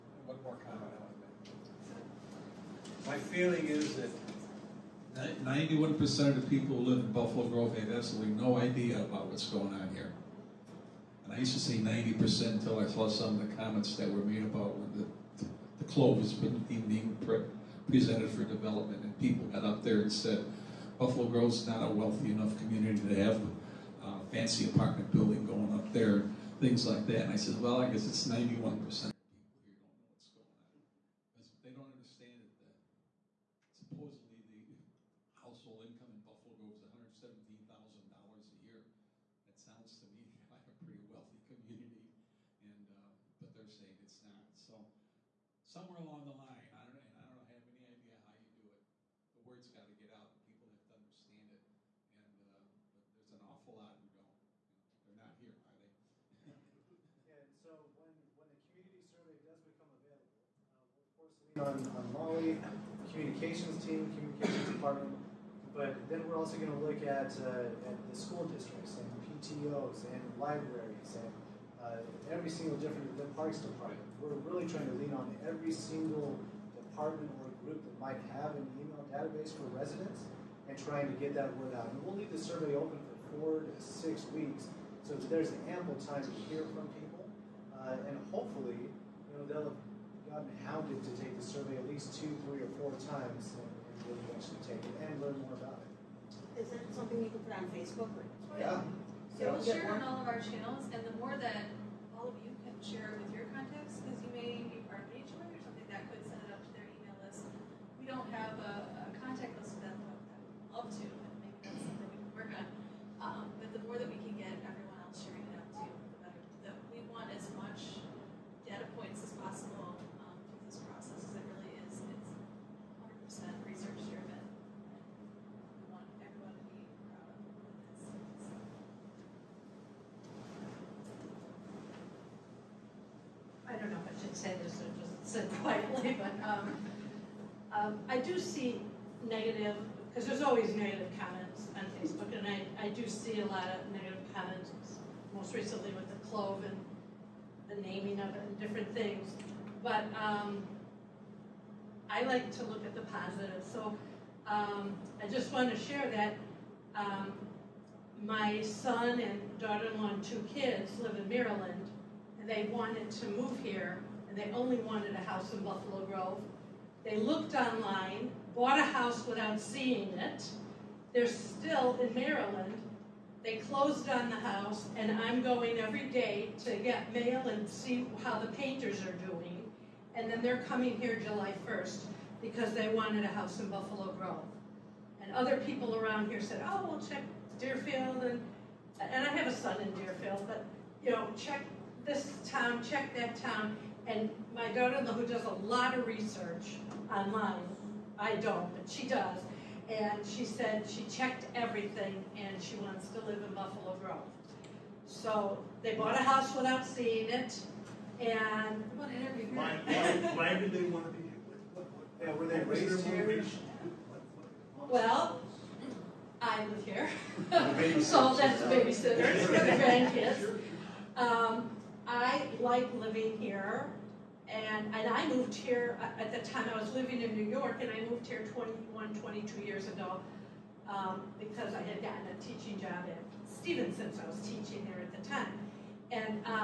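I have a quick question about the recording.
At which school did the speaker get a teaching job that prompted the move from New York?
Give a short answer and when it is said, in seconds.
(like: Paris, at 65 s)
Stevenson, at 233 s.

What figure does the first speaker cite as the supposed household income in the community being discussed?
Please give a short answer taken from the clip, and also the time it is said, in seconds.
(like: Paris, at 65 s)
$117,000, at 36 s.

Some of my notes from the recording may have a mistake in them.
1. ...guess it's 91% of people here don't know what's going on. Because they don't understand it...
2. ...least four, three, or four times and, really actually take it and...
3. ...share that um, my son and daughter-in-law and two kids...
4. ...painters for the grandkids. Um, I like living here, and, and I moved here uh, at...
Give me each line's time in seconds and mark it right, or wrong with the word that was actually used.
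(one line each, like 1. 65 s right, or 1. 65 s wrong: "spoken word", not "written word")
1. 27 s right
2. 91 s wrong: "two", not "four"
3. 155 s right
4. 218 s wrong: "babysitters", not "painters".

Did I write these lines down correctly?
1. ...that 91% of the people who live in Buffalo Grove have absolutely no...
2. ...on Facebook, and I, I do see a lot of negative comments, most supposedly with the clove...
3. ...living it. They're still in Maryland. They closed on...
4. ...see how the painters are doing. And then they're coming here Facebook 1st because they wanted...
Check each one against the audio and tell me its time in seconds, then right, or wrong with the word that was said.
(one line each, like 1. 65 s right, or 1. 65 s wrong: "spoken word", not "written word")
1. 3 s right
2. 141 s wrong: "recently", not "supposedly"
3. 169 s wrong: "seeing", not "living"
4. 177 s wrong: "July", not "Facebook".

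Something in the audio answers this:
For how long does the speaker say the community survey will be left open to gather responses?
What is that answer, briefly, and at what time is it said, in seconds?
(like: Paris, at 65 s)
4 to 6 weeks, at 83 s.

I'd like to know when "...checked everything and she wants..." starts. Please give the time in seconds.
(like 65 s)
201 s.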